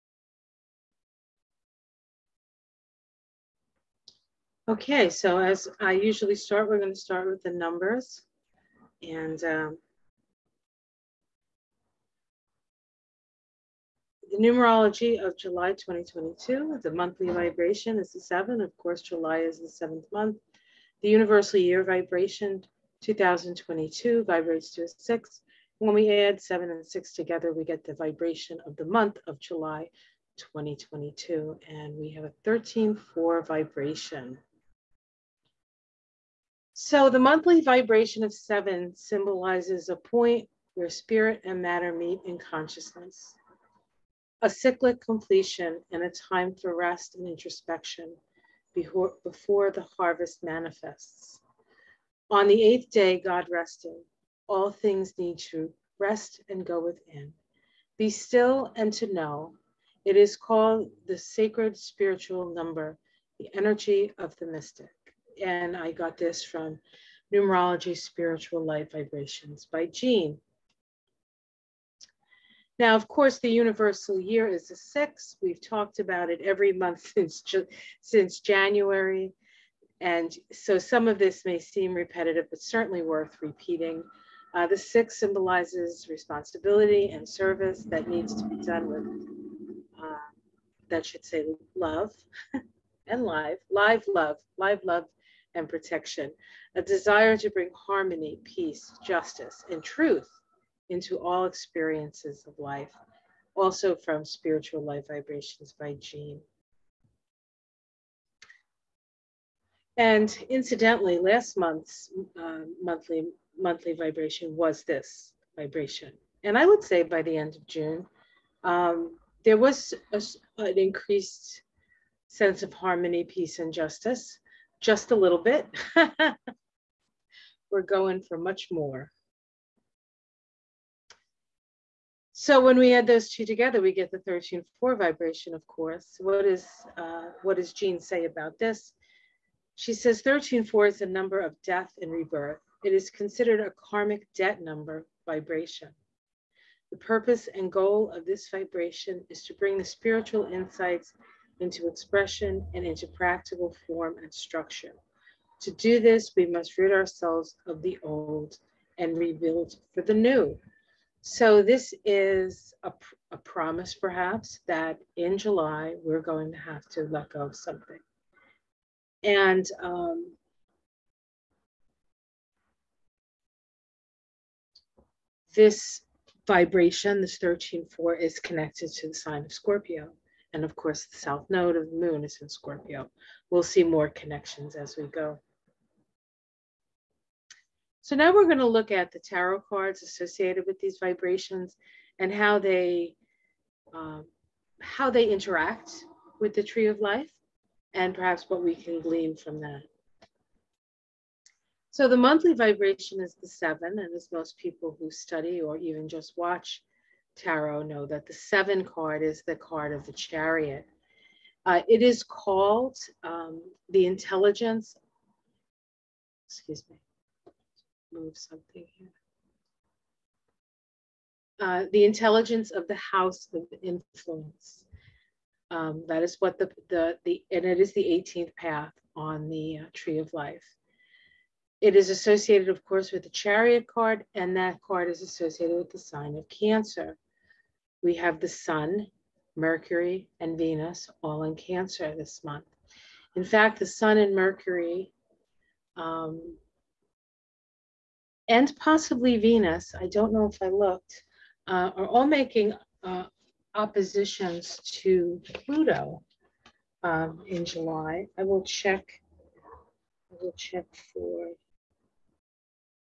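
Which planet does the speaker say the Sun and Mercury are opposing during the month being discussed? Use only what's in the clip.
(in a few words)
Pluto.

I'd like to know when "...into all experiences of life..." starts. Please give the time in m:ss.
1:40.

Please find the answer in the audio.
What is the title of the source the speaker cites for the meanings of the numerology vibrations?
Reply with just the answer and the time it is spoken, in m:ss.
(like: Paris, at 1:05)
Numerology Spiritual Light Vibrations, at 1:07.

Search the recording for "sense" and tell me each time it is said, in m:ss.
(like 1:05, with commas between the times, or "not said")
2:02.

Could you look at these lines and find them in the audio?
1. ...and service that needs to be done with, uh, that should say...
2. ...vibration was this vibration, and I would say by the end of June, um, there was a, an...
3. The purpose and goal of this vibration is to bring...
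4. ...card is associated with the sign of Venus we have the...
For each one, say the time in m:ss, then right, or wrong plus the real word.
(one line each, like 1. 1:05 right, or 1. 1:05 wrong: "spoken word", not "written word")
1. 1:27 right
2. 1:53 right
3. 2:26 right
4. 3:54 wrong: "Cancer", not "Venus".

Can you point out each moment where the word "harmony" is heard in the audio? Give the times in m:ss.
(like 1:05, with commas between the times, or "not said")
1:37, 2:02.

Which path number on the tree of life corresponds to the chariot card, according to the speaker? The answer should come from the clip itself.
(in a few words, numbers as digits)
18th.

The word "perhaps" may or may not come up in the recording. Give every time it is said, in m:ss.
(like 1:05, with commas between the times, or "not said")
2:43, 3:18.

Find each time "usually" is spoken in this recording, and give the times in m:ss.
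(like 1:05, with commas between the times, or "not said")
0:05.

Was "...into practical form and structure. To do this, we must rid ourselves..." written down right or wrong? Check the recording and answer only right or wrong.
right.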